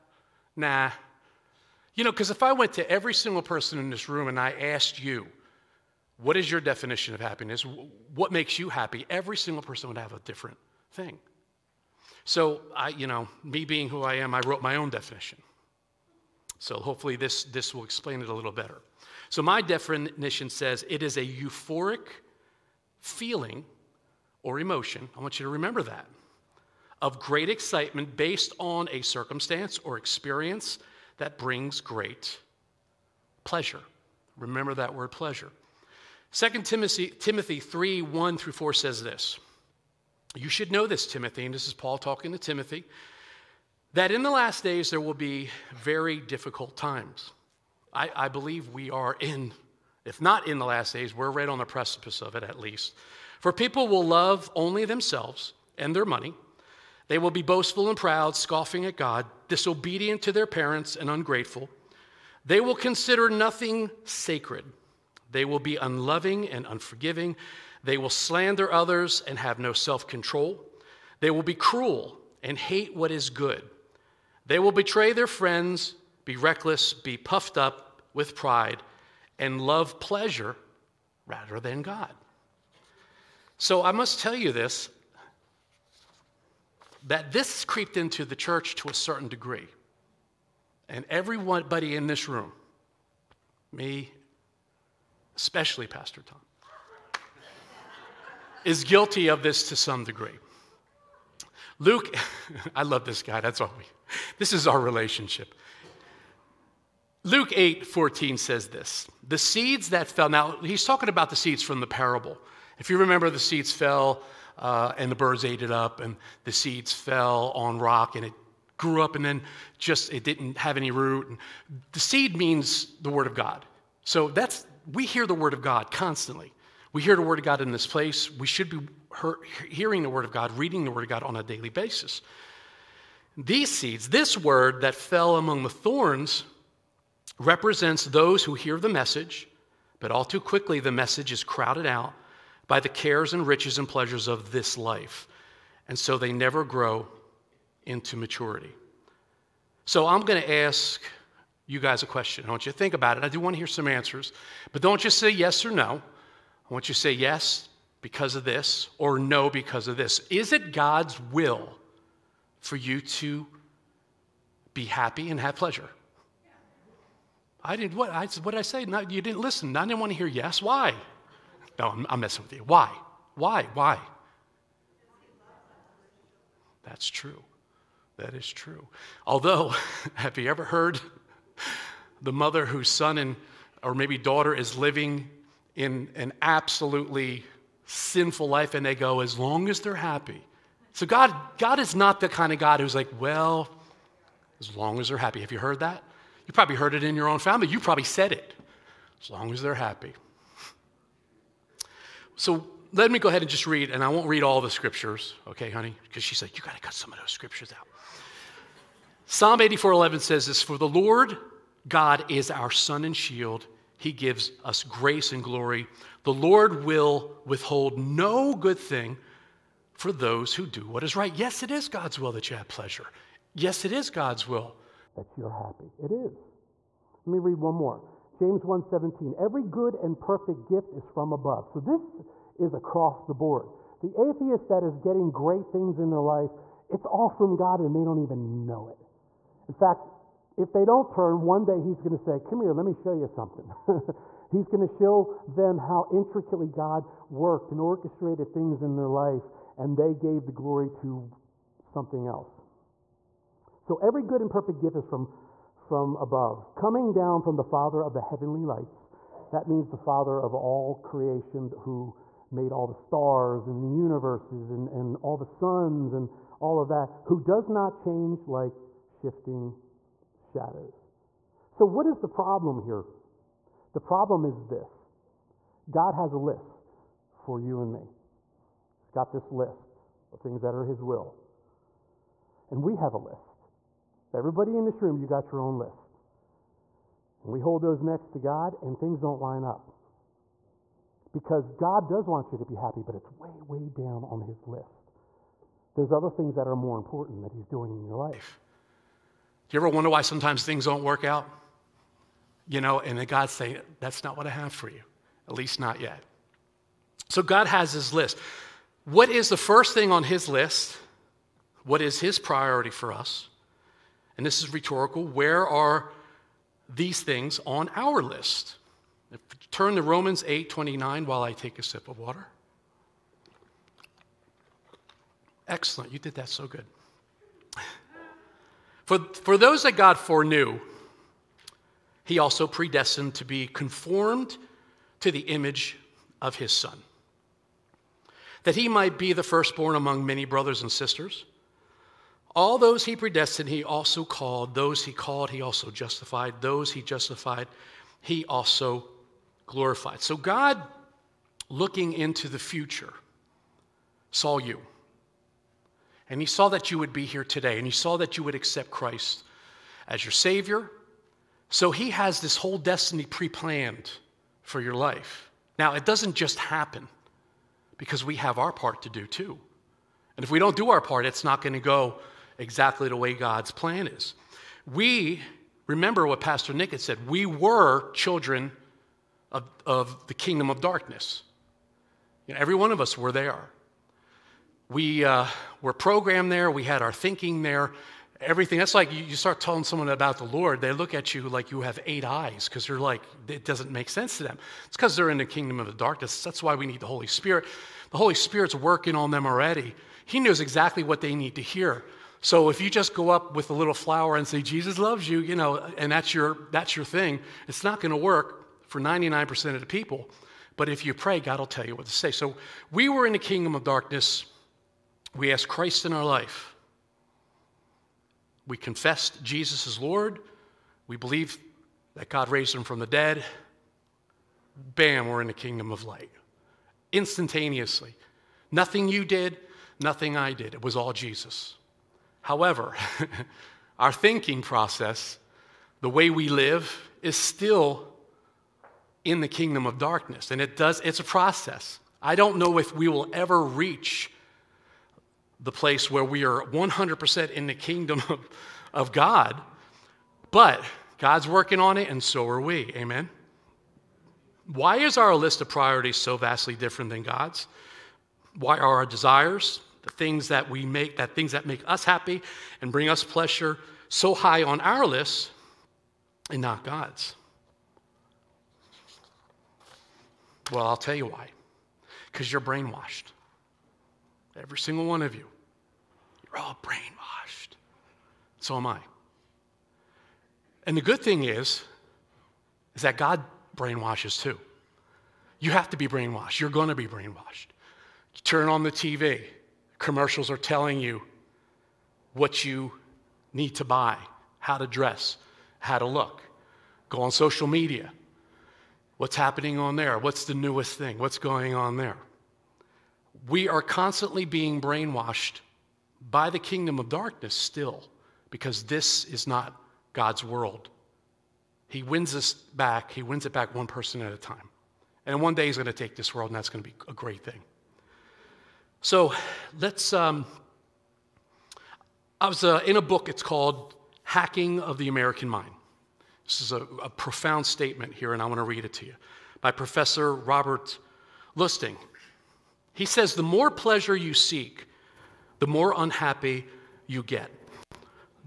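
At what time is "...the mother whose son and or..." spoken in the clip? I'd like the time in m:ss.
3:02.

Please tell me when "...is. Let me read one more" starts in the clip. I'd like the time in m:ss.
3:46.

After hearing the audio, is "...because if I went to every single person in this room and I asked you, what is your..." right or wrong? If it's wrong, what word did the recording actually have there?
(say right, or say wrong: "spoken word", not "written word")
right.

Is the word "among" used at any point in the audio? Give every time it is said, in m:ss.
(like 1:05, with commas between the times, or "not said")
2:15, 5:39.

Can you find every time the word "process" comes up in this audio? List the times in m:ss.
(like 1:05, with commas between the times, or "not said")
7:14, 7:21.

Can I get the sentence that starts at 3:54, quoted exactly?
The atheist that is getting great things in their life, it's all from God and they don't even know it.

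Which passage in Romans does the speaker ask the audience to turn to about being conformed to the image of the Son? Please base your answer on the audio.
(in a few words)
Romans 8:29.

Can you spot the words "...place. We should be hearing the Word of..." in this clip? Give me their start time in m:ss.
2:07.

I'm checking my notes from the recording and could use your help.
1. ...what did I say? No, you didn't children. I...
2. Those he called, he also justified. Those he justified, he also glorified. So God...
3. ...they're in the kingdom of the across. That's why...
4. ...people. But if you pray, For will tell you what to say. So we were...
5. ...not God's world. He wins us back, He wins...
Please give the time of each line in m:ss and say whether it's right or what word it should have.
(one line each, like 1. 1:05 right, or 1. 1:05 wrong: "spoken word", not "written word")
1. 2:48 wrong: "listen", not "children"
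2. 5:44 right
3. 6:35 wrong: "darkness", not "across"
4. 6:49 wrong: "God", not "For"
5. 8:29 right.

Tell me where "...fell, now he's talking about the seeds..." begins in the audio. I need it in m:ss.
1:50.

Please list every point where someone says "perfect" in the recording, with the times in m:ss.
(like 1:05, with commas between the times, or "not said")
3:50, 4:14.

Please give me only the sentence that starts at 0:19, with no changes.
So my definition says it is a euphoric feeling or emotion.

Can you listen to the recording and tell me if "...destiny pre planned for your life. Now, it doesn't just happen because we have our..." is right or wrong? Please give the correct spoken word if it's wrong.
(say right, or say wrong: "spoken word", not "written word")
right.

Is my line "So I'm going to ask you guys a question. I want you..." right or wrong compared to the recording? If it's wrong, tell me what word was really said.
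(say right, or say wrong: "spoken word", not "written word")
right.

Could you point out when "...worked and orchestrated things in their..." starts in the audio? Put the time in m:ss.
4:07.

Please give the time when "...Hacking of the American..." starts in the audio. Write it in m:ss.
8:44.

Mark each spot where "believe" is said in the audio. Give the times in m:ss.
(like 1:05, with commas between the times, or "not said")
0:48, 7:01.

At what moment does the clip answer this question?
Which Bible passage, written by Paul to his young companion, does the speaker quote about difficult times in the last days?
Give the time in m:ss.
0:36.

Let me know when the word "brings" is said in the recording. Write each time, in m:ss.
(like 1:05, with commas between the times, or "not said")
0:31, 7:42.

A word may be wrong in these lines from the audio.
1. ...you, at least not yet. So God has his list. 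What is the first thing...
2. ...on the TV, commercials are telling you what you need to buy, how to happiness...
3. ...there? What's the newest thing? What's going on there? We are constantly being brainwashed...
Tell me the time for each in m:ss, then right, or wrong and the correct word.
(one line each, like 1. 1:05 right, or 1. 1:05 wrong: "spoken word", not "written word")
1. 5:04 right
2. 8:08 wrong: "dress", not "happiness"
3. 8:19 right.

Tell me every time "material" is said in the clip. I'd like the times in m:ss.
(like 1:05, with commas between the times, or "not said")
not said.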